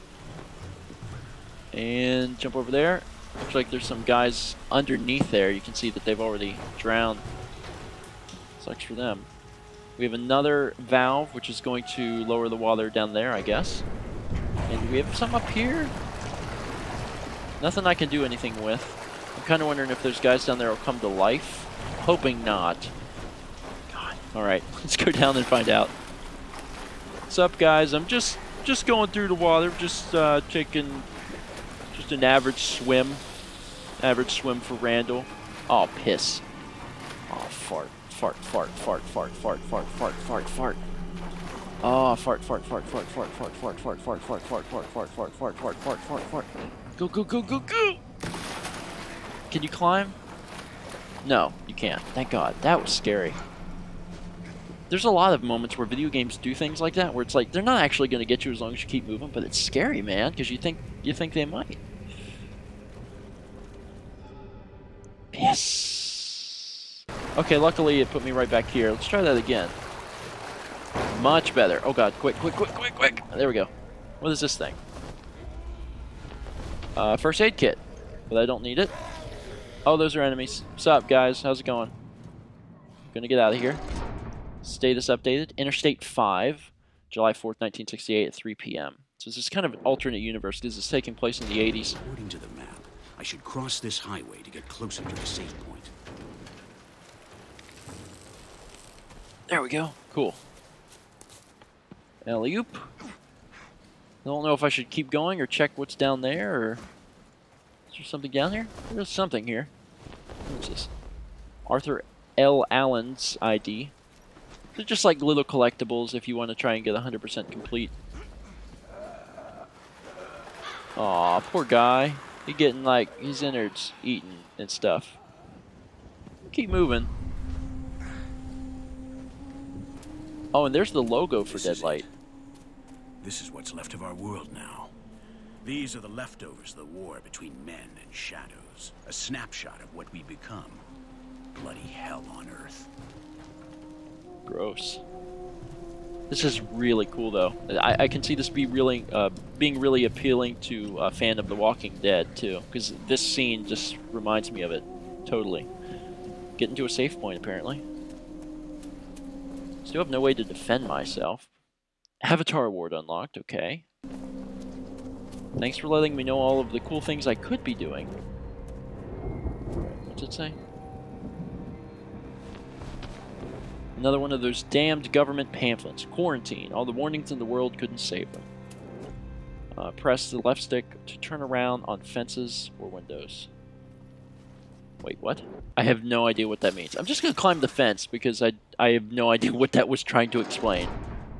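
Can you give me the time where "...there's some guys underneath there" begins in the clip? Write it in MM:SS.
00:03.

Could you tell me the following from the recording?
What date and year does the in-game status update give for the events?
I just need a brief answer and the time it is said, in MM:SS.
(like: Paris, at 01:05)
July 4th, 1968, at 01:27.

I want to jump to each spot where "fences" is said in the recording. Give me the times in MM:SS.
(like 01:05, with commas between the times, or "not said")
03:02, 03:07.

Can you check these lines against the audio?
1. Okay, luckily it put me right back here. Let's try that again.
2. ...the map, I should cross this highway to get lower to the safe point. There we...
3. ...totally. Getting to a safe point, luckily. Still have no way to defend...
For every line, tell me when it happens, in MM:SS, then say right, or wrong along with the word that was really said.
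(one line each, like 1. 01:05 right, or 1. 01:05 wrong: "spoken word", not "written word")
1. 01:07 right
2. 01:32 wrong: "closer", not "lower"
3. 02:35 wrong: "apparently", not "luckily".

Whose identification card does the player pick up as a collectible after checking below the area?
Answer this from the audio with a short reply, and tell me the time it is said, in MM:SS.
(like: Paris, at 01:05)
Arthur L. Allen, at 01:51.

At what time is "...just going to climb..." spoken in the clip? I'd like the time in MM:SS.
03:07.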